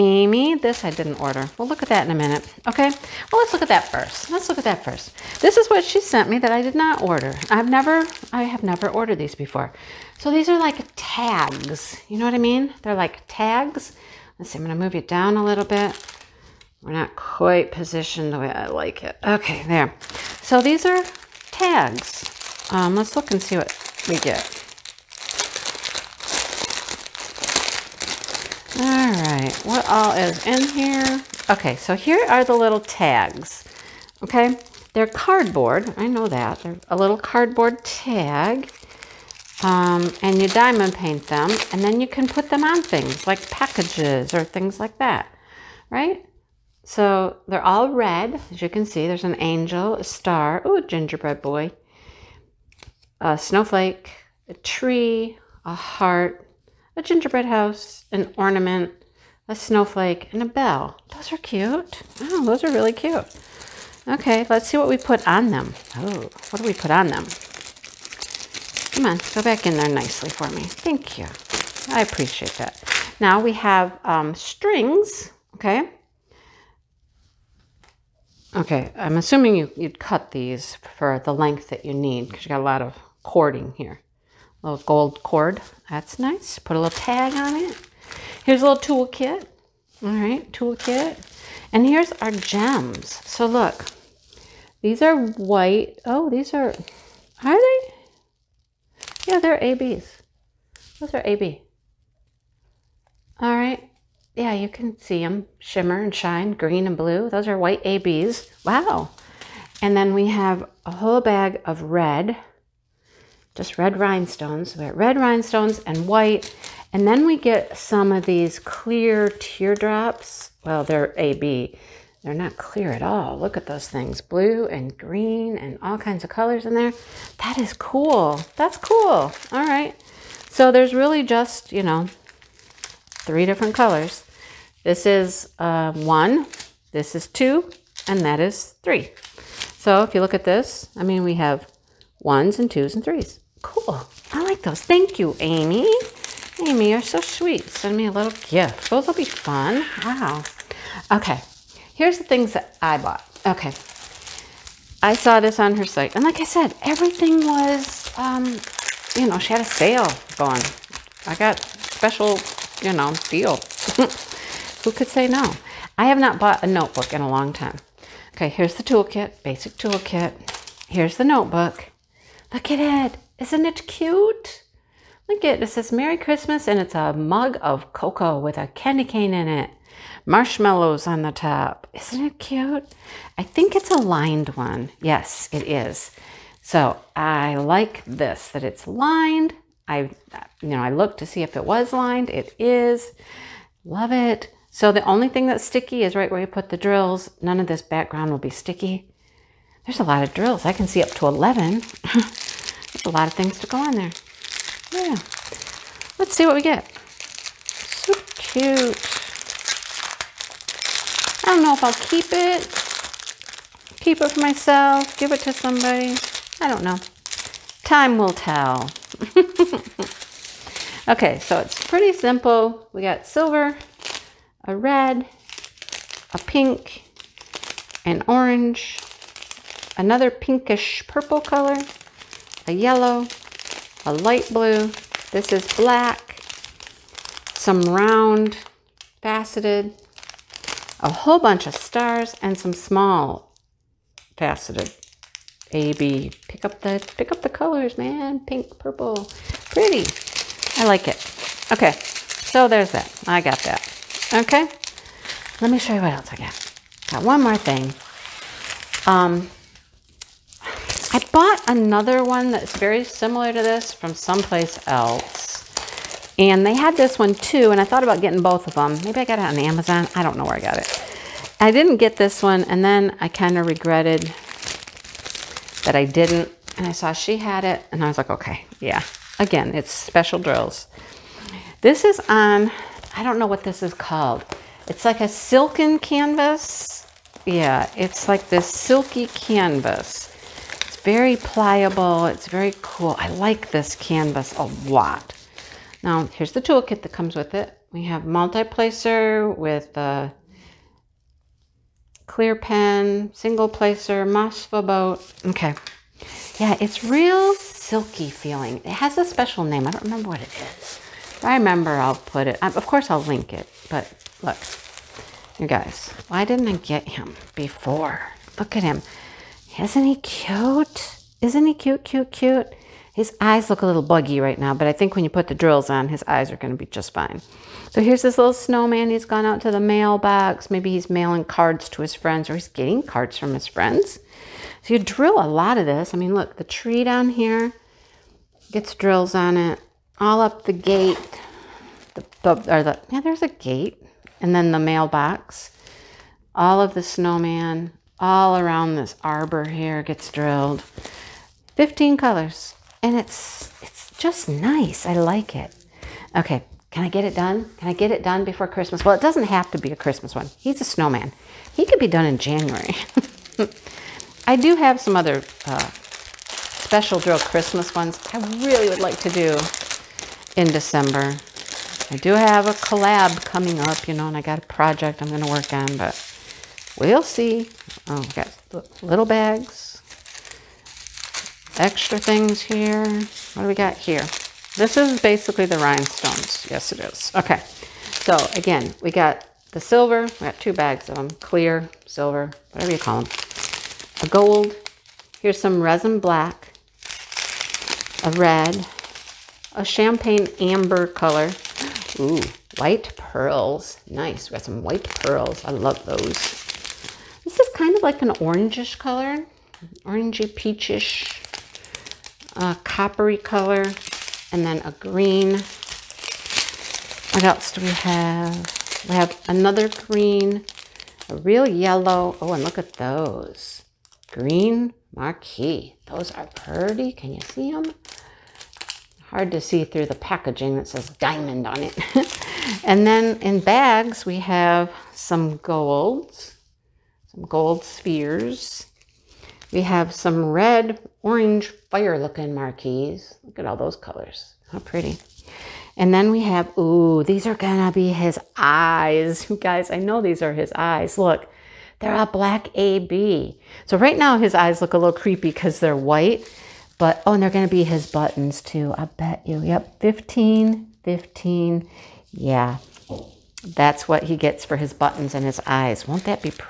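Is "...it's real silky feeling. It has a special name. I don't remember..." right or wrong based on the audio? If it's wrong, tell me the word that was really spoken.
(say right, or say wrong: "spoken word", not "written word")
right.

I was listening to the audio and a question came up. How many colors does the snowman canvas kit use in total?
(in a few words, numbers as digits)
15.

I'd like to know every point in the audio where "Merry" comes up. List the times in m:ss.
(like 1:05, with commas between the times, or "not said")
2:55.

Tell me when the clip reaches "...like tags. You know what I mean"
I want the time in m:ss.
0:10.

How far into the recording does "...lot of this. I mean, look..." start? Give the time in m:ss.
5:35.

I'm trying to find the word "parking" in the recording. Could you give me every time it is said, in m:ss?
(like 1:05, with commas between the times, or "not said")
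not said.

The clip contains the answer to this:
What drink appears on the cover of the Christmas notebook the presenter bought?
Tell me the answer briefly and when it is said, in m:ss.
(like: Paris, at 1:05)
Cocoa, at 2:56.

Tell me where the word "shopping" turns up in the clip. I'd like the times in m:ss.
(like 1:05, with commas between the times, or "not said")
not said.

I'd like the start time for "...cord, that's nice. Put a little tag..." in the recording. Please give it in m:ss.
1:25.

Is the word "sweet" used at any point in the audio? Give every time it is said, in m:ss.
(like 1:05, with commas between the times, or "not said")
2:27.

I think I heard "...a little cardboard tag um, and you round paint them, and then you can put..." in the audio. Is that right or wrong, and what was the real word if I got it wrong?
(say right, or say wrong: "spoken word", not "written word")
wrong: "diamond", not "round".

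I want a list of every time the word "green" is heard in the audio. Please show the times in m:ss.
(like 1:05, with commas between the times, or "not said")
1:46, 2:04, 6:54, 6:59, 7:04.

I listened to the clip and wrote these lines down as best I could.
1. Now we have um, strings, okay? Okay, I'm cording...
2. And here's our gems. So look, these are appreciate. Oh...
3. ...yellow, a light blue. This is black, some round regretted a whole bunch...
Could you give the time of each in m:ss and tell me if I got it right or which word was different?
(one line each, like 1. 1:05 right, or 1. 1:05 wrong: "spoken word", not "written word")
1. 1:13 wrong: "assuming", not "cording"
2. 1:31 wrong: "white", not "appreciate"
3. 3:52 wrong: "faceted", not "regretted".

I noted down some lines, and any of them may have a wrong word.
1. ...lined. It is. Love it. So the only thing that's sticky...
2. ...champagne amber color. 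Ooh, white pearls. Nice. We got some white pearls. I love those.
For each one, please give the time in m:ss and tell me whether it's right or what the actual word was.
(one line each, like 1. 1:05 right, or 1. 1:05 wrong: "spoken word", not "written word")
1. 3:11 right
2. 6:39 right.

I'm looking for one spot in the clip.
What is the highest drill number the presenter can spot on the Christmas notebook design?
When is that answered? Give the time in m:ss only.
3:20.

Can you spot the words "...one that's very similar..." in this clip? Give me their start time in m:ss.
4:22.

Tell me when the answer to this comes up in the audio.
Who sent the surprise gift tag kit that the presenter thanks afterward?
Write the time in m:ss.
2:24.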